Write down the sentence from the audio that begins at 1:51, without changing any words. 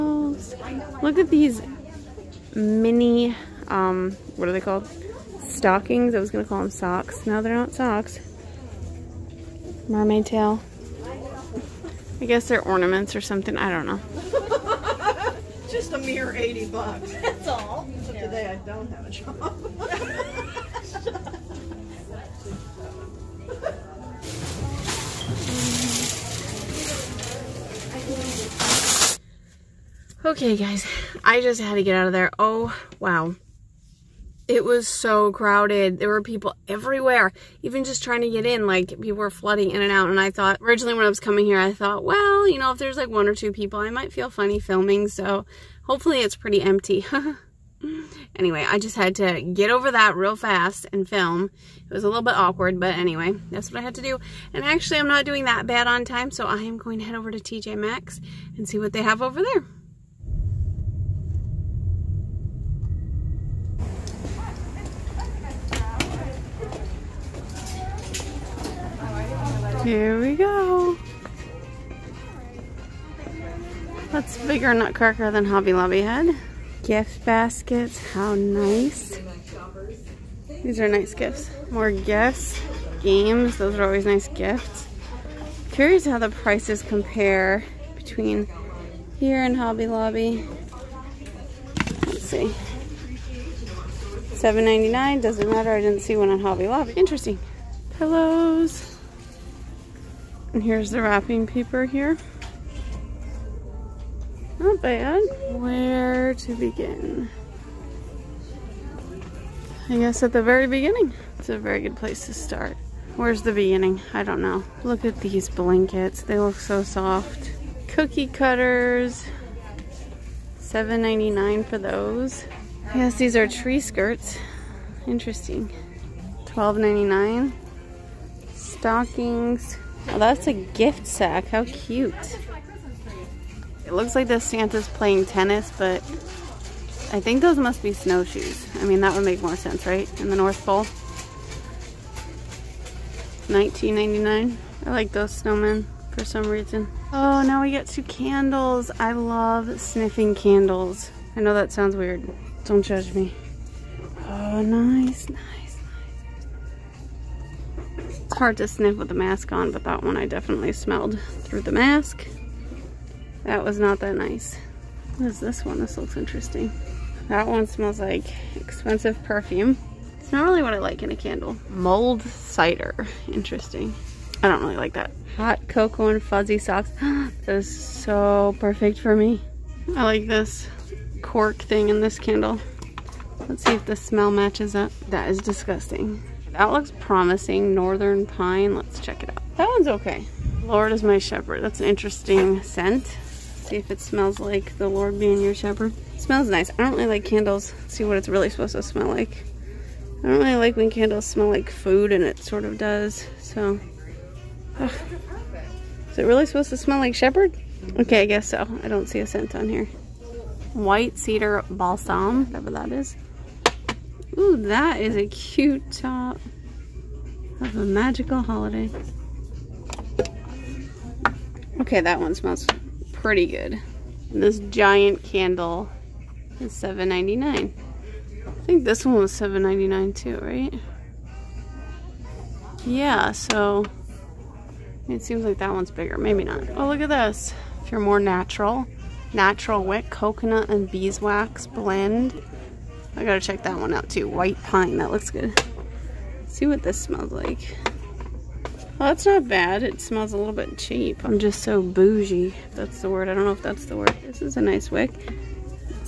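It's a very good place to start.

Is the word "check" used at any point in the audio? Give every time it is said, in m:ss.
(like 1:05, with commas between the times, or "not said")
3:08, 4:03.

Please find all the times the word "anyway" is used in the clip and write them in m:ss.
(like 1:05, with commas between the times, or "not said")
0:48, 0:52.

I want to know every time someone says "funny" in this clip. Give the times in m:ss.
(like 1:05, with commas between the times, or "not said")
0:44.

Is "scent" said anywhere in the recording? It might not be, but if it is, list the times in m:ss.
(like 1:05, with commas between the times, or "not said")
3:12, 3:29.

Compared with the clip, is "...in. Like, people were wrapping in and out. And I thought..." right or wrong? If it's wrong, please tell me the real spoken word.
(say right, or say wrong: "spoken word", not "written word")
wrong: "flooding", not "wrapping".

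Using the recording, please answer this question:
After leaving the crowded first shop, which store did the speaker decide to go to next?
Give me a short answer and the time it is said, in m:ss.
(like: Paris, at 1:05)
TJ Maxx, at 0:57.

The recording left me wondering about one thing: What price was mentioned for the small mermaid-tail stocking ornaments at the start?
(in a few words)
80 bucks.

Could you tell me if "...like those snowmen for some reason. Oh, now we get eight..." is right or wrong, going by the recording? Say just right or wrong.
wrong.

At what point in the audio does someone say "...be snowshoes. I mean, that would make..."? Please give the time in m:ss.
2:17.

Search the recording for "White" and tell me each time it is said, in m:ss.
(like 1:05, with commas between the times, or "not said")
3:30, 4:04.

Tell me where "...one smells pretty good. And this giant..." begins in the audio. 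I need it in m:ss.
3:42.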